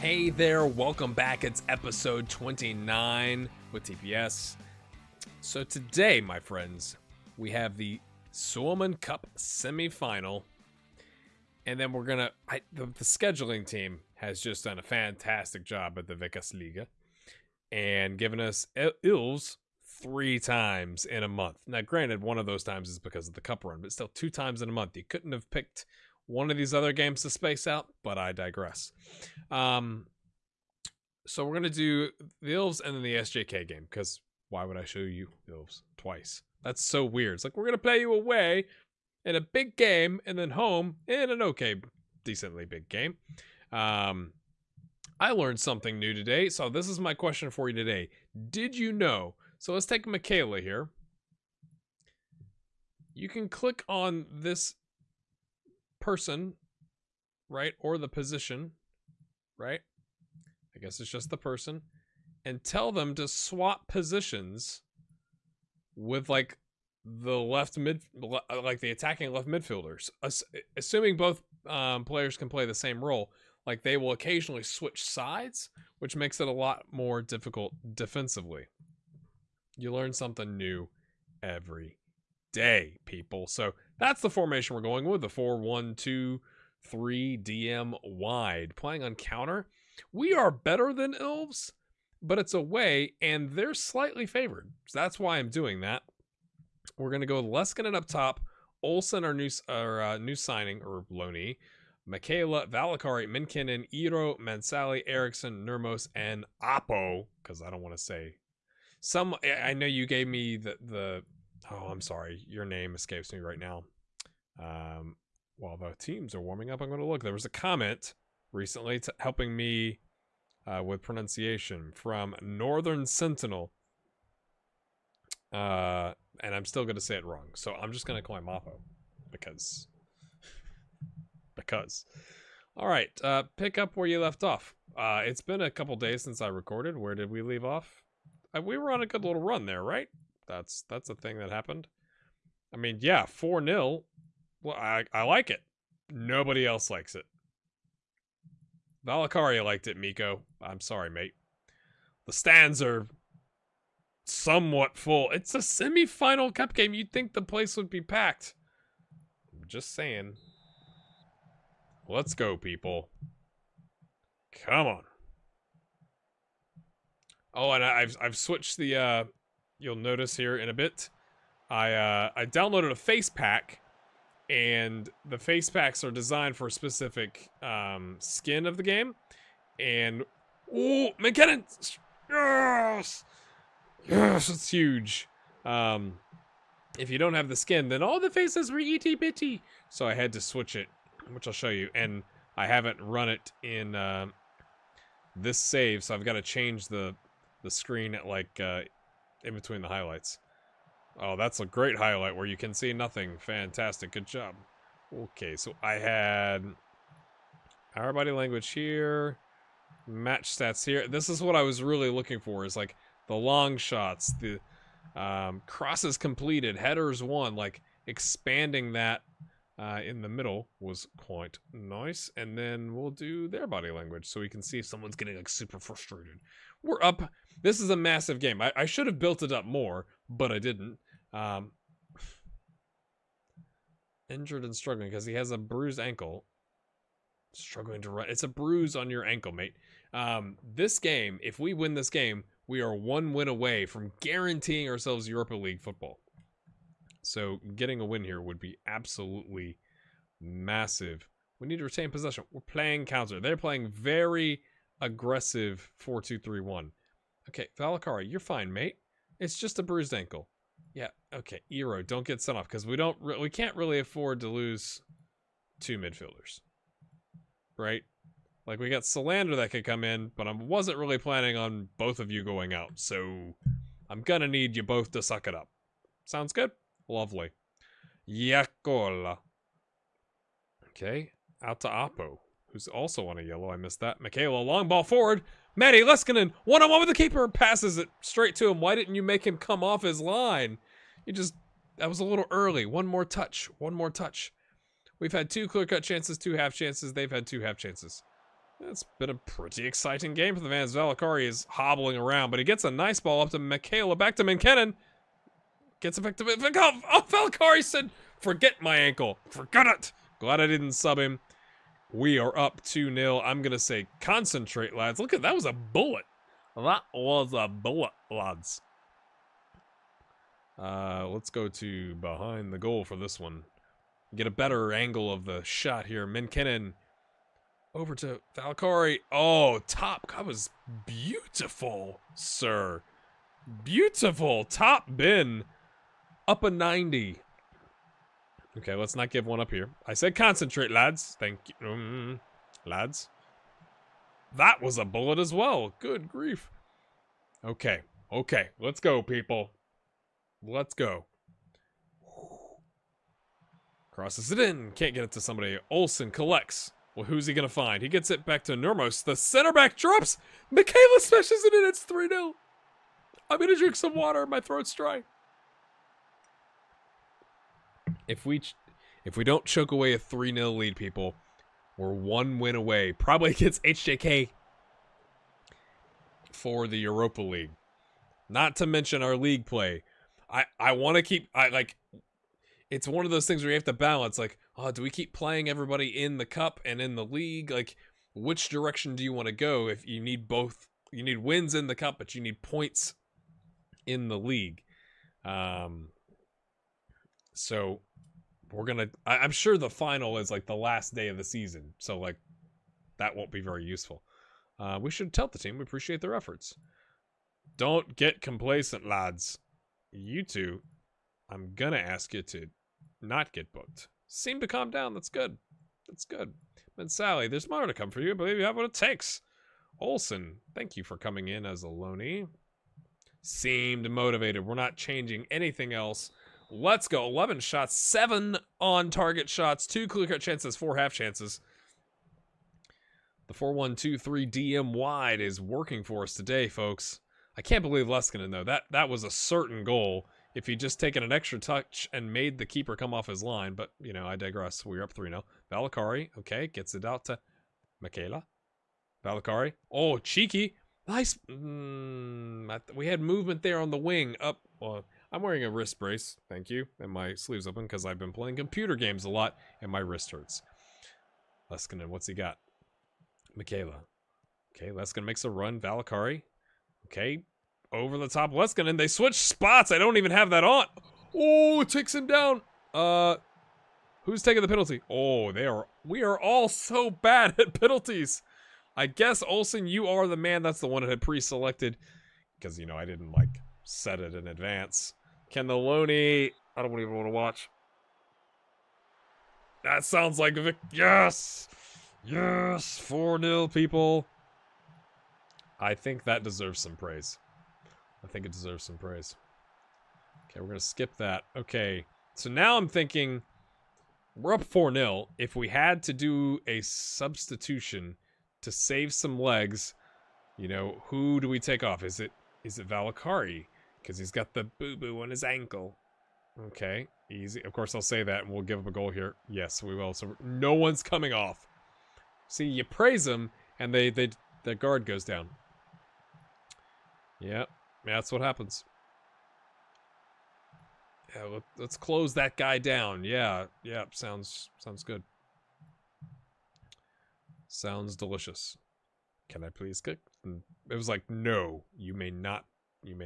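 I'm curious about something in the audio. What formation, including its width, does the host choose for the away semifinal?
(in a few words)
4-1-2-3 DM wide.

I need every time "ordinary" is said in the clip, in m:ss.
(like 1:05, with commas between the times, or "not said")
not said.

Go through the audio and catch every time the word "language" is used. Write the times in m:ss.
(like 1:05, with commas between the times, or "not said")
3:28, 3:43.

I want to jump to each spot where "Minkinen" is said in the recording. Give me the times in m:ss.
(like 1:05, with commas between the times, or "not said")
1:43, 5:26.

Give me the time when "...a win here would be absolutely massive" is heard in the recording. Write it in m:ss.
4:07.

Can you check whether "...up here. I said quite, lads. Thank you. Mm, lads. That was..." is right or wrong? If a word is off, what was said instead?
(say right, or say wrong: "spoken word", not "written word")
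wrong: "concentrate", not "quite".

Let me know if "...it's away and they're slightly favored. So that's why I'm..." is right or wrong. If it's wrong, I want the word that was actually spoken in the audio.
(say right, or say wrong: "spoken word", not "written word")
right.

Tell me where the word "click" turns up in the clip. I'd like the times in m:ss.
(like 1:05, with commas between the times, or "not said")
0:53, 9:00.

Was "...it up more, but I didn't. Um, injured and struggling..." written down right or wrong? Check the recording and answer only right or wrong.
right.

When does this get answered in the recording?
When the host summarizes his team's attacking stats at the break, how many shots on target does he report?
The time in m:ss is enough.
7:07.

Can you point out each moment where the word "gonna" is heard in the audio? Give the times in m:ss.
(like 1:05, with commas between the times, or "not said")
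4:34, 6:38, 6:51.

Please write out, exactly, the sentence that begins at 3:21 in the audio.
Oh, that's a great highlight where you can see nothing.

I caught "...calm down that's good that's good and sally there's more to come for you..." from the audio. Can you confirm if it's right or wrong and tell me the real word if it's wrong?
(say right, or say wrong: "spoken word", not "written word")
right.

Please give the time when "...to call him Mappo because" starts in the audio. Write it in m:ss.
2:08.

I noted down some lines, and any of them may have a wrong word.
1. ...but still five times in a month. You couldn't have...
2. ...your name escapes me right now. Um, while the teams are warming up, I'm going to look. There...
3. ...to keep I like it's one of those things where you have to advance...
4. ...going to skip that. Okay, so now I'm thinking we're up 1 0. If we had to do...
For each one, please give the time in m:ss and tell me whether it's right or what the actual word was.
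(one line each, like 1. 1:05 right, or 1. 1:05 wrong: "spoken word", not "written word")
1. 0:23 wrong: "two", not "five"
2. 1:52 right
3. 6:21 wrong: "balance", not "advance"
4. 8:20 wrong: "4", not "1".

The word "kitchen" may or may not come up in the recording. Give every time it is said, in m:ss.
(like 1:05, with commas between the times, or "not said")
not said.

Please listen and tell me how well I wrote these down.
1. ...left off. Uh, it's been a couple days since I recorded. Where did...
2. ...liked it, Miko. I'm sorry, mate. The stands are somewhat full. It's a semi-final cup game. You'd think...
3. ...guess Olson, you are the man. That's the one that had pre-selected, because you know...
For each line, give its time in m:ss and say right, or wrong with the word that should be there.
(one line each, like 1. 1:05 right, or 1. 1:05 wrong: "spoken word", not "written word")
1. 2:14 right
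2. 2:29 right
3. 7:59 right.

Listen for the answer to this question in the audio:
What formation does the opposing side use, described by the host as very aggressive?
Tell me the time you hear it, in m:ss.
4:16.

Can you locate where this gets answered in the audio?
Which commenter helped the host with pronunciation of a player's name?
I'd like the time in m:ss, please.
2:02.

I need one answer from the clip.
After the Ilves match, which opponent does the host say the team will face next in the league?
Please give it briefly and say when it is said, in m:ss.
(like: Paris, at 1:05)
SJK, at 0:33.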